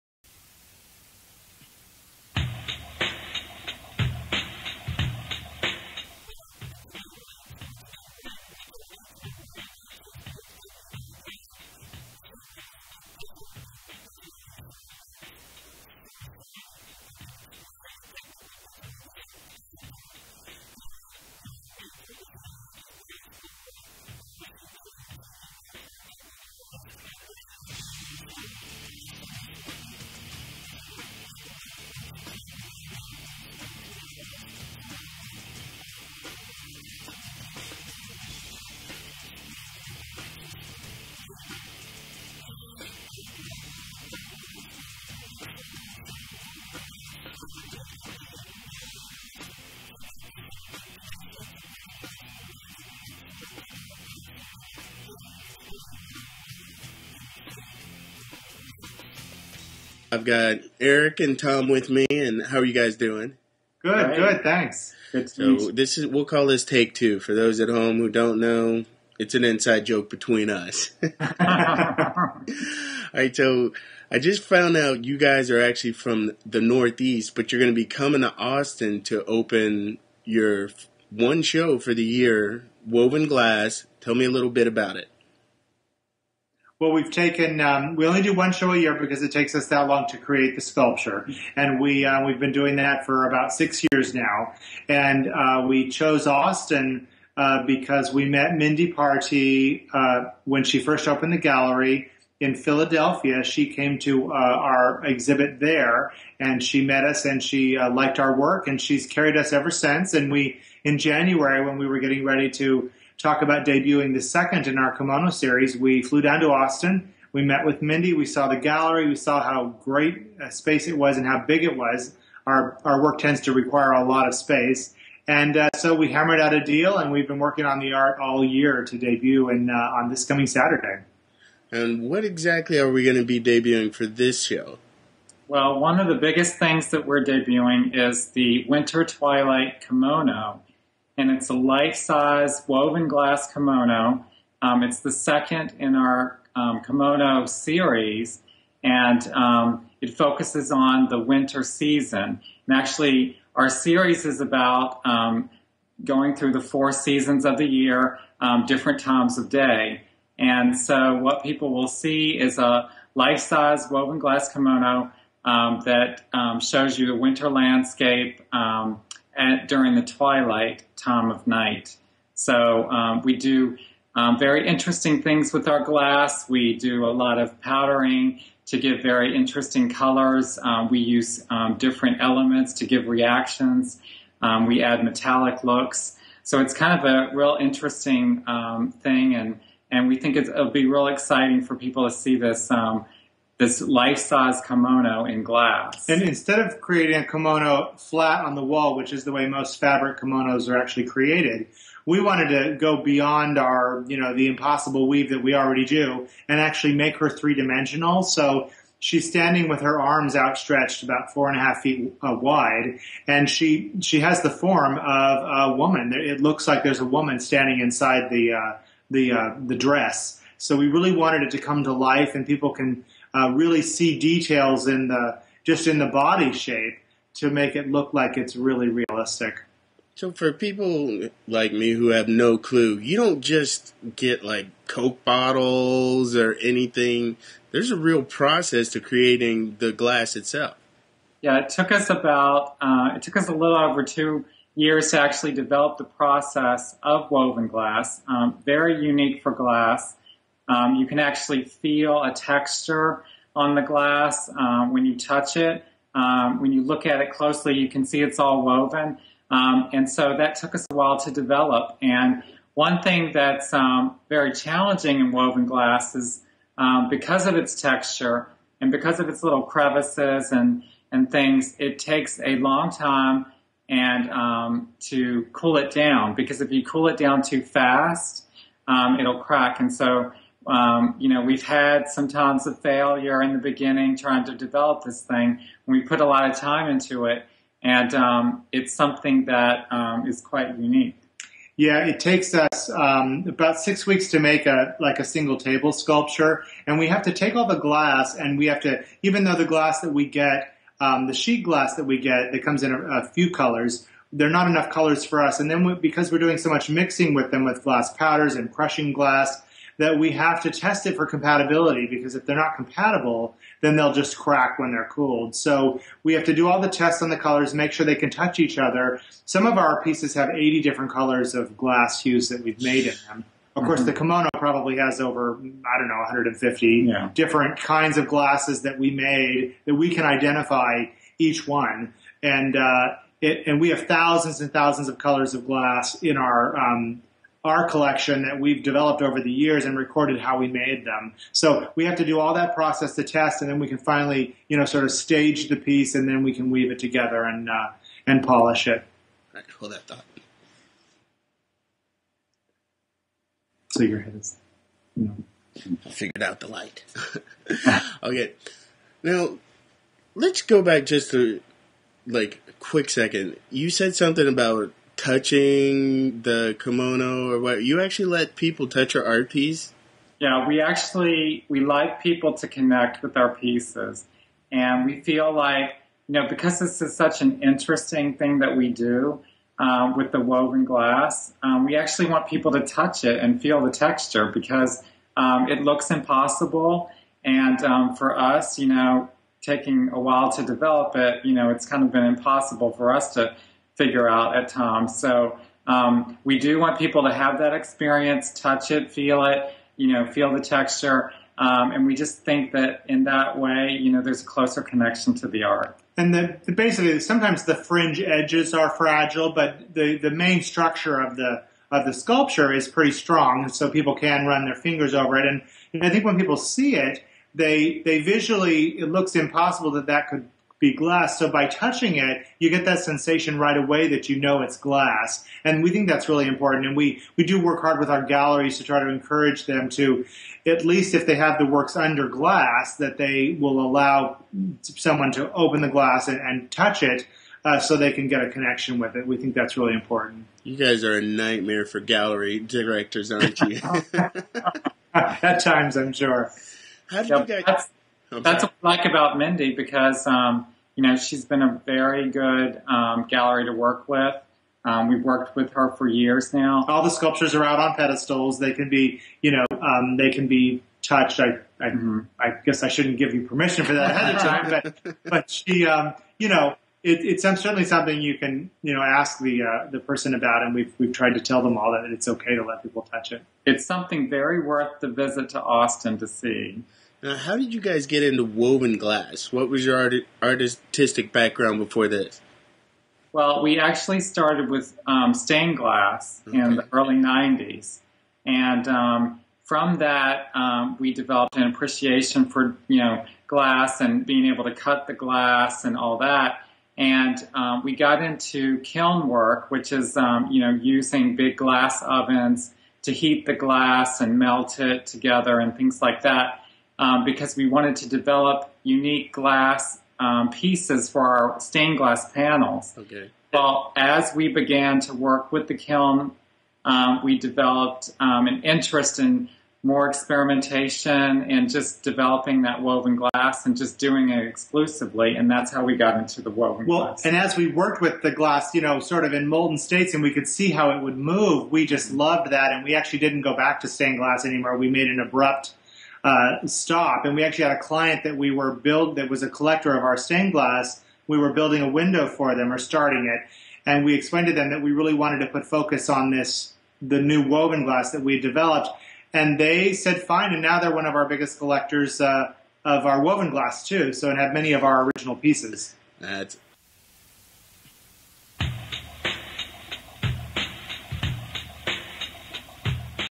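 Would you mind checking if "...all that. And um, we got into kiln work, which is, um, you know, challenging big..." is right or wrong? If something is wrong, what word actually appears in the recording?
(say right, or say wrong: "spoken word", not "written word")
wrong: "using", not "challenging".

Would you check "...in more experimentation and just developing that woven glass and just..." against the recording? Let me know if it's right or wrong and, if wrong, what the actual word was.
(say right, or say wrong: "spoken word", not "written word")
right.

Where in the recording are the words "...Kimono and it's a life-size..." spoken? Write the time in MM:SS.
02:19.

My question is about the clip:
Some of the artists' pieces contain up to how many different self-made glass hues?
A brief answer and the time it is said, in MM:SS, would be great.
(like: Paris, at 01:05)
80, at 05:20.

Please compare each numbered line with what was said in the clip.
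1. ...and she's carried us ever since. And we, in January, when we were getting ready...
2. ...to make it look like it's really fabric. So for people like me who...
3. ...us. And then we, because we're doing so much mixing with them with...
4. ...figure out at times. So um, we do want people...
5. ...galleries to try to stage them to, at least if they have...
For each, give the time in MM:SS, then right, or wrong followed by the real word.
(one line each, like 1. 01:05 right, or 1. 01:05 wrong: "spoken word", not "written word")
1. 01:48 right
2. 03:47 wrong: "realistic", not "fabric"
3. 05:05 right
4. 06:34 right
5. 07:08 wrong: "encourage", not "stage".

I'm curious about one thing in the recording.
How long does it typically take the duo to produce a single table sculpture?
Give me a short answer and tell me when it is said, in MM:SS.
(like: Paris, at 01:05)
6 weeks, at 04:53.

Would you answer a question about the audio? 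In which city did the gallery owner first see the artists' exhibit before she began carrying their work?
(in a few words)
Philadelphia.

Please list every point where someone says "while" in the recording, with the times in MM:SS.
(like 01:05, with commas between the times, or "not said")
04:20, 06:30.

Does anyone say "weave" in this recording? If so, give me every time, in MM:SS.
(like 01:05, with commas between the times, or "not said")
03:25, 05:46.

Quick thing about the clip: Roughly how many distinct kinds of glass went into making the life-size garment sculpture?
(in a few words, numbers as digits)
Over 150.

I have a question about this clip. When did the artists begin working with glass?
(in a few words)
Early 90s.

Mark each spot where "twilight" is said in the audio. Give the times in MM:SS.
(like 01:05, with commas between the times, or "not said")
02:19, 02:50.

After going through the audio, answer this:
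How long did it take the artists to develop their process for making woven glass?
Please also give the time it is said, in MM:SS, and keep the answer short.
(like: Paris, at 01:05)
Over 2 years, at 04:03.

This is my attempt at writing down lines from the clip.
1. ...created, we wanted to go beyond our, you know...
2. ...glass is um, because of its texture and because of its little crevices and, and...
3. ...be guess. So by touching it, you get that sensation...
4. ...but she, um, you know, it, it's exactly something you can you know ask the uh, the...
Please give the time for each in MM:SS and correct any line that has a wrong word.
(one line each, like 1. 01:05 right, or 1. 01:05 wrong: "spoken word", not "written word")
1. 03:21 right
2. 04:25 right
3. 07:00 wrong: "glass", not "guess"
4. 07:45 wrong: "certainly", not "exactly".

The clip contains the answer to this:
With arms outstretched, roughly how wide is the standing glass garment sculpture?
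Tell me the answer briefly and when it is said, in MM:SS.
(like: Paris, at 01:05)
4.5 feet, at 03:31.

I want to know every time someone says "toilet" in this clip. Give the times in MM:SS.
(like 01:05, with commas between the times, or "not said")
not said.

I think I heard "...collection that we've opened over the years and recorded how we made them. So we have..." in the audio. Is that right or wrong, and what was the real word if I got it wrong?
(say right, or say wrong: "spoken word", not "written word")
wrong: "developed", not "opened".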